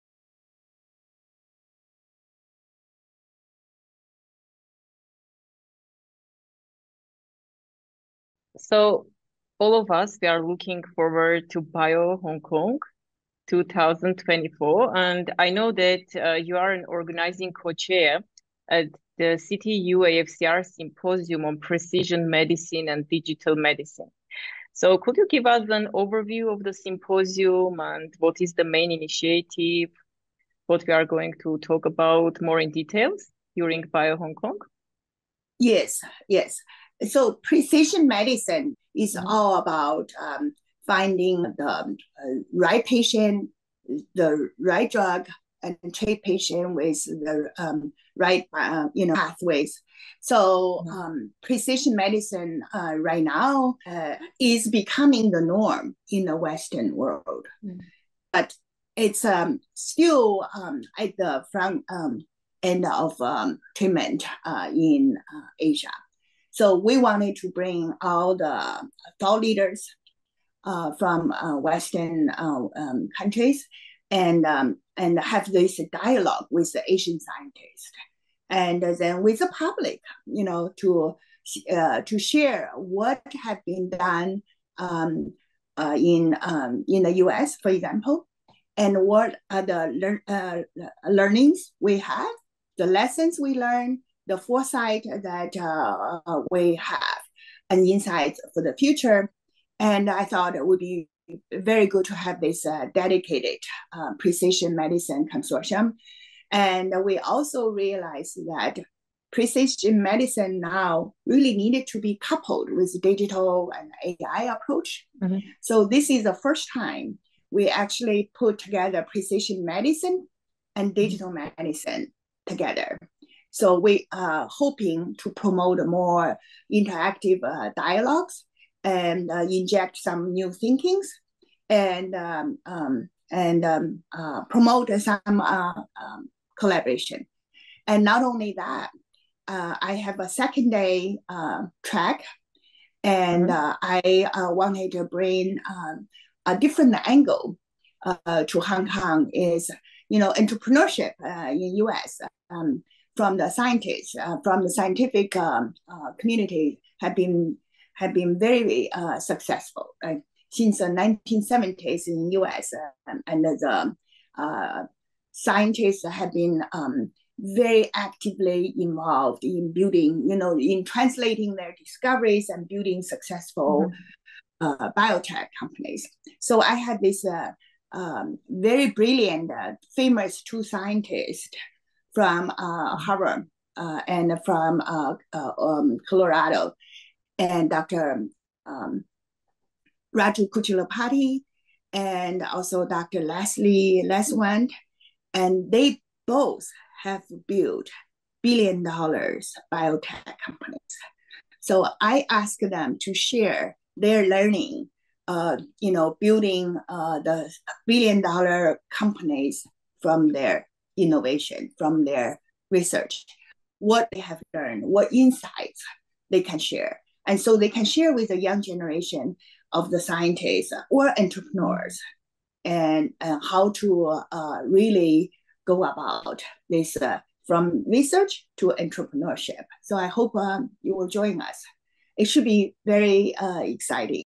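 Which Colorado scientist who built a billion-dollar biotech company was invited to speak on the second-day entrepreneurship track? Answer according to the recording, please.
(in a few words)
Leslie Leinwand.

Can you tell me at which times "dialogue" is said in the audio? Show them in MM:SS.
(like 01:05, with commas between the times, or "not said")
01:15, 02:07.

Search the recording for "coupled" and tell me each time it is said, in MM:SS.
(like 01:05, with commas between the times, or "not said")
01:52.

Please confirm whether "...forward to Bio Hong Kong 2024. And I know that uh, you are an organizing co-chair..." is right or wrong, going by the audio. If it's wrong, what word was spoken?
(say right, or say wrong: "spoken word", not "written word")
right.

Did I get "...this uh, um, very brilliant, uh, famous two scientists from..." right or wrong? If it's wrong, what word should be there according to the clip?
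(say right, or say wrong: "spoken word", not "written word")
right.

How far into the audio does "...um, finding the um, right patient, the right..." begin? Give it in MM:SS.
00:40.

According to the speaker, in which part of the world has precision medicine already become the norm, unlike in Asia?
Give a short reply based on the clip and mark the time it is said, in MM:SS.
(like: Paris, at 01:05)
Western world, at 00:56.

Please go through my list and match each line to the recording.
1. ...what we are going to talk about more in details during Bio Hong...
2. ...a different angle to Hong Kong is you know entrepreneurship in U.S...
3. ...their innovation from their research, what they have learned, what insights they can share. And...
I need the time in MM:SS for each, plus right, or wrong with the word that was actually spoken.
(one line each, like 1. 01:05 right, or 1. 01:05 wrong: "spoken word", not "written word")
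1. 00:30 right
2. 02:26 right
3. 03:30 right.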